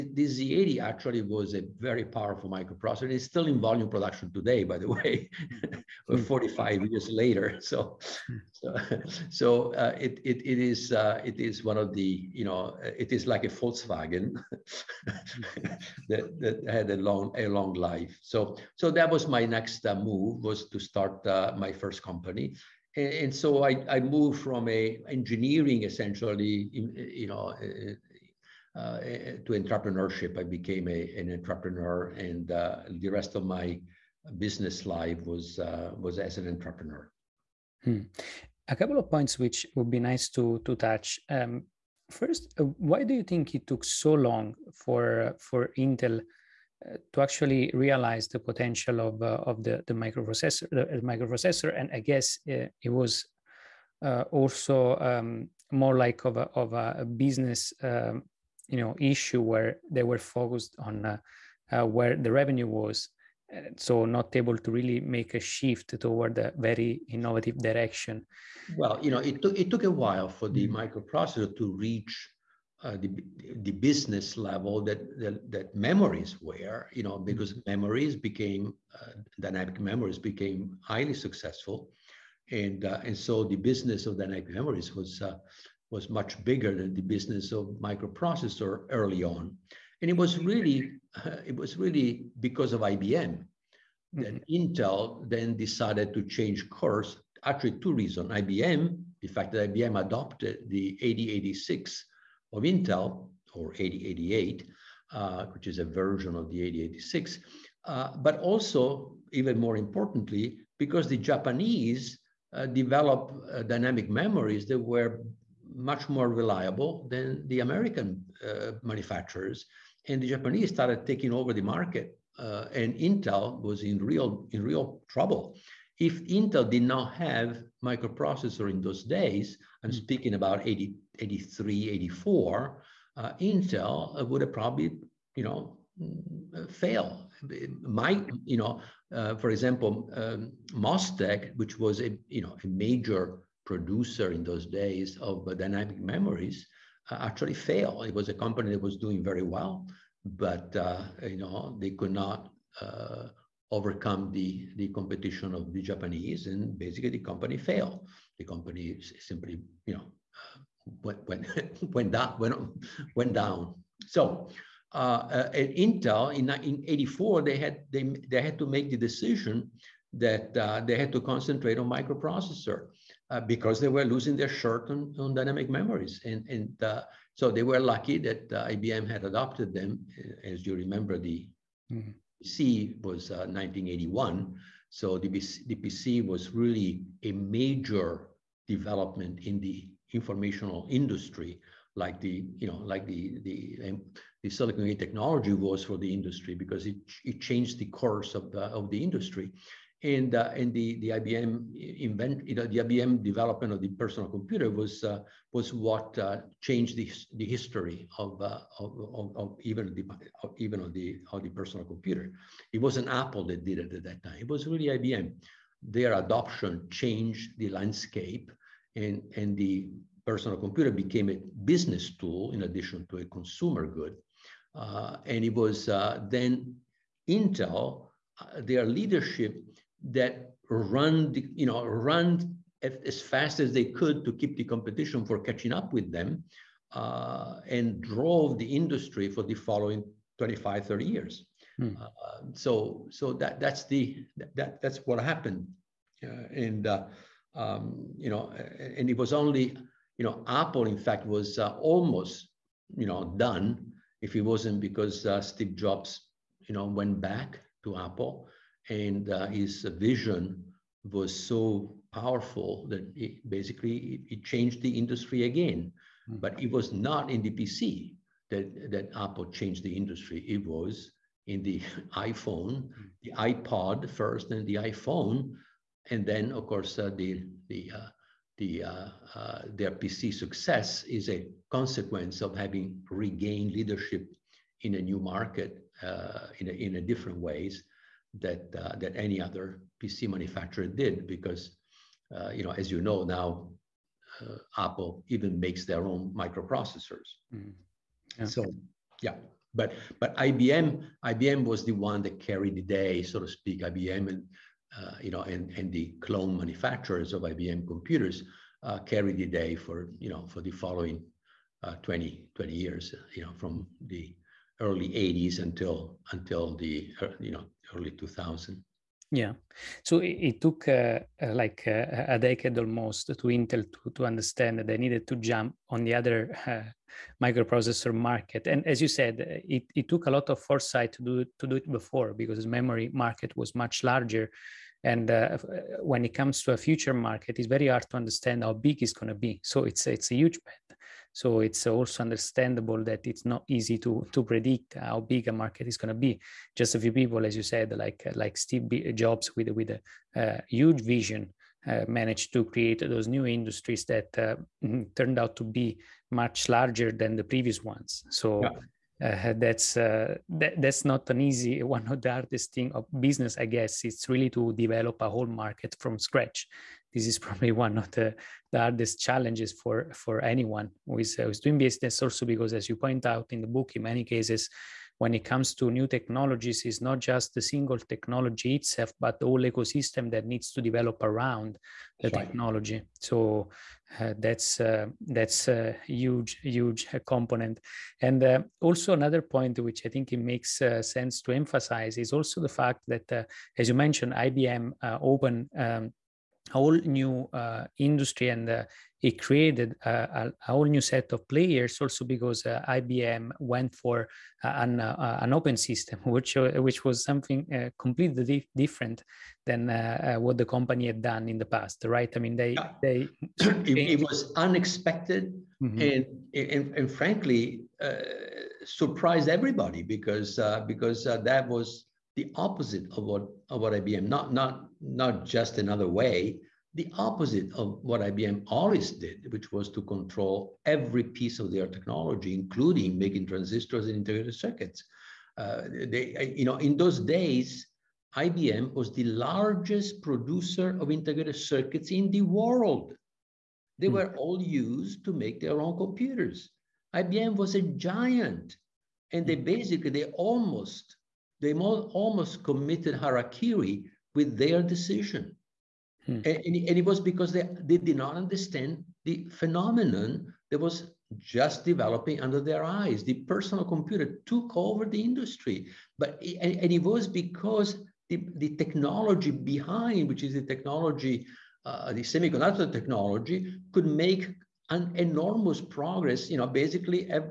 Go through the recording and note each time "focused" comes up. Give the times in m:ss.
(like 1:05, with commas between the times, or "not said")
1:00.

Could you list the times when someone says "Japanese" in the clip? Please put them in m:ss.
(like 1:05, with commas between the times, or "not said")
1:51, 2:00, 2:35.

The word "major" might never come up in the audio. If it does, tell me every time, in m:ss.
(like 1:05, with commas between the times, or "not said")
2:22, 3:07.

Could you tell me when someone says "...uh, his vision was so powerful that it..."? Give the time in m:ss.
4:19.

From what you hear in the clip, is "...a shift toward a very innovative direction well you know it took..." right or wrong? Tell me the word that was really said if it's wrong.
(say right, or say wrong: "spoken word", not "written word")
right.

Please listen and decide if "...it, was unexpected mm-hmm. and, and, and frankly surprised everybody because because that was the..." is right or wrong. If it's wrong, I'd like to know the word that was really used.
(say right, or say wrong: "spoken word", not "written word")
right.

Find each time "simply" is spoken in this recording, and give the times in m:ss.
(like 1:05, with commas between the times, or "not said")
2:39.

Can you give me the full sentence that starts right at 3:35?
Their adoption changed the landscape, and and the personal computer became a business tool in addition to a consumer good.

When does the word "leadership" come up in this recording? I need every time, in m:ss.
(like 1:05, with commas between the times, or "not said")
3:48, 4:43.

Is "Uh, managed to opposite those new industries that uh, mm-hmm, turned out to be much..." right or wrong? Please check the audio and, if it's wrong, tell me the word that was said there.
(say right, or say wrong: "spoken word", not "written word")
wrong: "create", not "opposite".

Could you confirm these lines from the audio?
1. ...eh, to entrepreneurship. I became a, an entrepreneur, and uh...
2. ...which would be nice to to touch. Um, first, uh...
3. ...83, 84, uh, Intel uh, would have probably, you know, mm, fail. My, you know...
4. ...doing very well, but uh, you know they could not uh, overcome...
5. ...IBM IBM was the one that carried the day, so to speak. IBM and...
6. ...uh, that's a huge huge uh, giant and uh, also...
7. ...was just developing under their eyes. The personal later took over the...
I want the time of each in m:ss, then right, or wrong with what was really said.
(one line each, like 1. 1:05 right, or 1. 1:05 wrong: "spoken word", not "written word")
1. 0:29 right
2. 0:39 right
3. 2:11 right
4. 2:28 right
5. 5:00 right
6. 6:24 wrong: "component", not "giant"
7. 7:40 wrong: "computer", not "later".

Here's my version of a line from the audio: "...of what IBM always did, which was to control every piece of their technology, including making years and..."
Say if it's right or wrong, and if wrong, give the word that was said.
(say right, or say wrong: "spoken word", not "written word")
wrong: "transistors", not "years".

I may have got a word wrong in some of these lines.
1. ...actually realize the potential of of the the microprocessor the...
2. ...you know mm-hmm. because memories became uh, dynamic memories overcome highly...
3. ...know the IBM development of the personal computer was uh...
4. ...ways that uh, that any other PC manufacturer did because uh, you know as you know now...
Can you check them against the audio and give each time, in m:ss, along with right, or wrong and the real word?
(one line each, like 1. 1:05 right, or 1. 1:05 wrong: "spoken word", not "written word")
1. 0:47 right
2. 1:16 wrong: "became", not "overcome"
3. 3:22 right
4. 4:47 right.